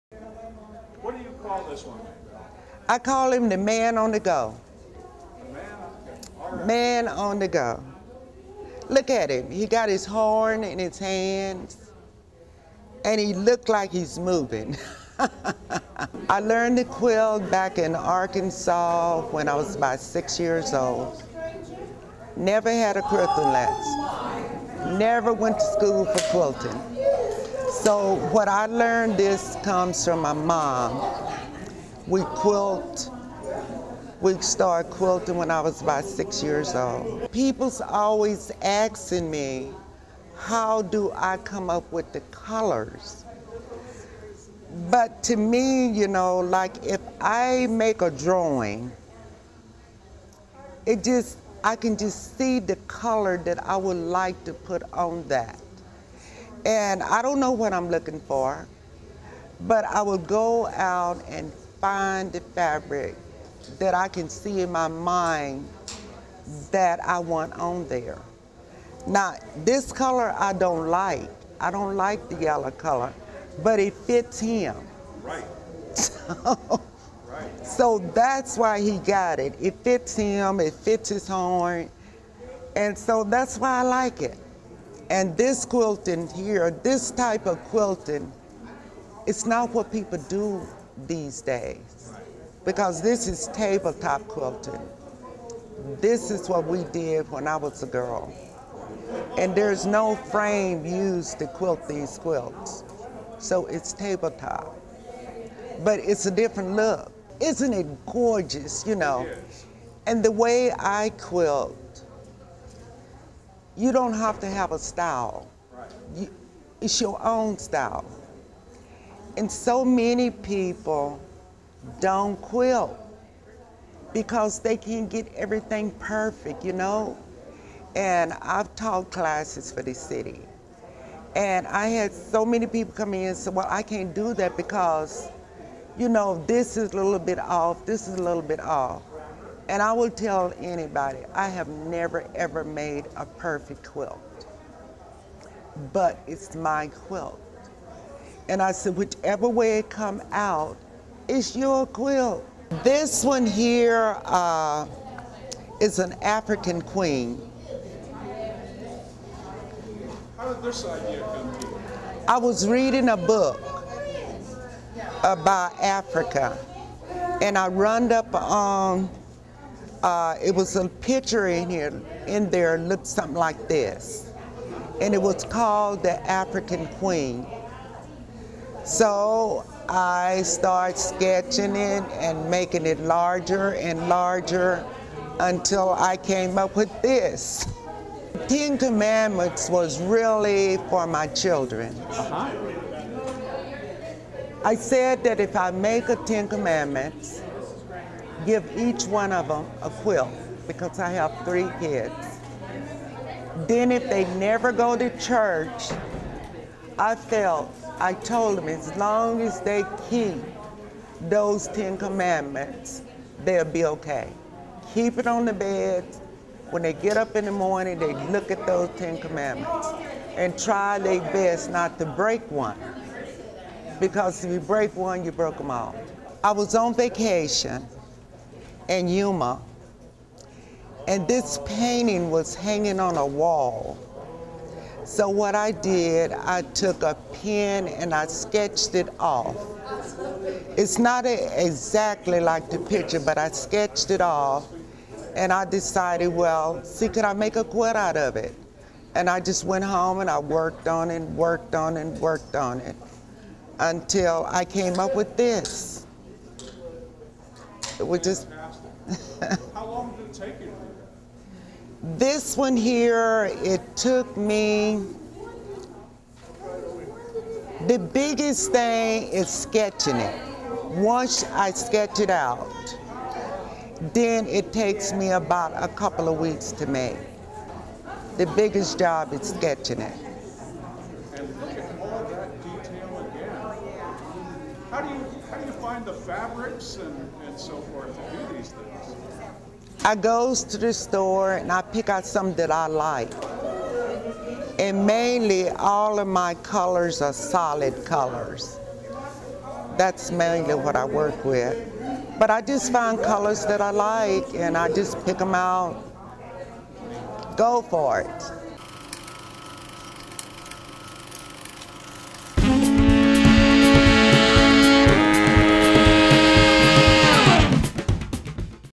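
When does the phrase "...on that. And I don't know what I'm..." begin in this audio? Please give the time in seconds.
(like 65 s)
54 s.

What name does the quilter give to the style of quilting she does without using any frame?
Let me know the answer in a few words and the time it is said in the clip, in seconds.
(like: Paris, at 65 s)
Tabletop quilting, at 93 s.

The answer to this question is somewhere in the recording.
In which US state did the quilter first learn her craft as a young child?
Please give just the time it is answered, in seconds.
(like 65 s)
17 s.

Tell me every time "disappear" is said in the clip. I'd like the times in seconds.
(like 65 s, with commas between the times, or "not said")
not said.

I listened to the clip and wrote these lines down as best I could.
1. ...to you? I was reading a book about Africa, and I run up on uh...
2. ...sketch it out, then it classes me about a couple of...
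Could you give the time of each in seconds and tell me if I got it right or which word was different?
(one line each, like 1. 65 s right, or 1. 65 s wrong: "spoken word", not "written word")
1. 161 s right
2. 271 s wrong: "takes", not "classes".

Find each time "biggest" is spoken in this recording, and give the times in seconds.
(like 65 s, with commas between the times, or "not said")
267 s, 278 s.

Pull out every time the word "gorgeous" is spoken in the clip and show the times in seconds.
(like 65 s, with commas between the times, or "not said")
108 s.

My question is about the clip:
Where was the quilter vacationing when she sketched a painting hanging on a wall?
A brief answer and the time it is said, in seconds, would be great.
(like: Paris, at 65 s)
Yuma, at 229 s.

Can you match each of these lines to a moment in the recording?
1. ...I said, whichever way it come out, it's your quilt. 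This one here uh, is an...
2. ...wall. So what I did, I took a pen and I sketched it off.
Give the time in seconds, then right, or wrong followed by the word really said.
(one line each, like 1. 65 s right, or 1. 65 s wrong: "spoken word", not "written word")
1. 148 s right
2. 233 s right.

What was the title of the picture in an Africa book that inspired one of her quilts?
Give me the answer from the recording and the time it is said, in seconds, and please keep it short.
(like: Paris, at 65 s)
The African Queen, at 176 s.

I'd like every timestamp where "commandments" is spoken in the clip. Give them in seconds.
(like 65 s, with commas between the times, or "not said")
188 s, 196 s, 211 s, 219 s.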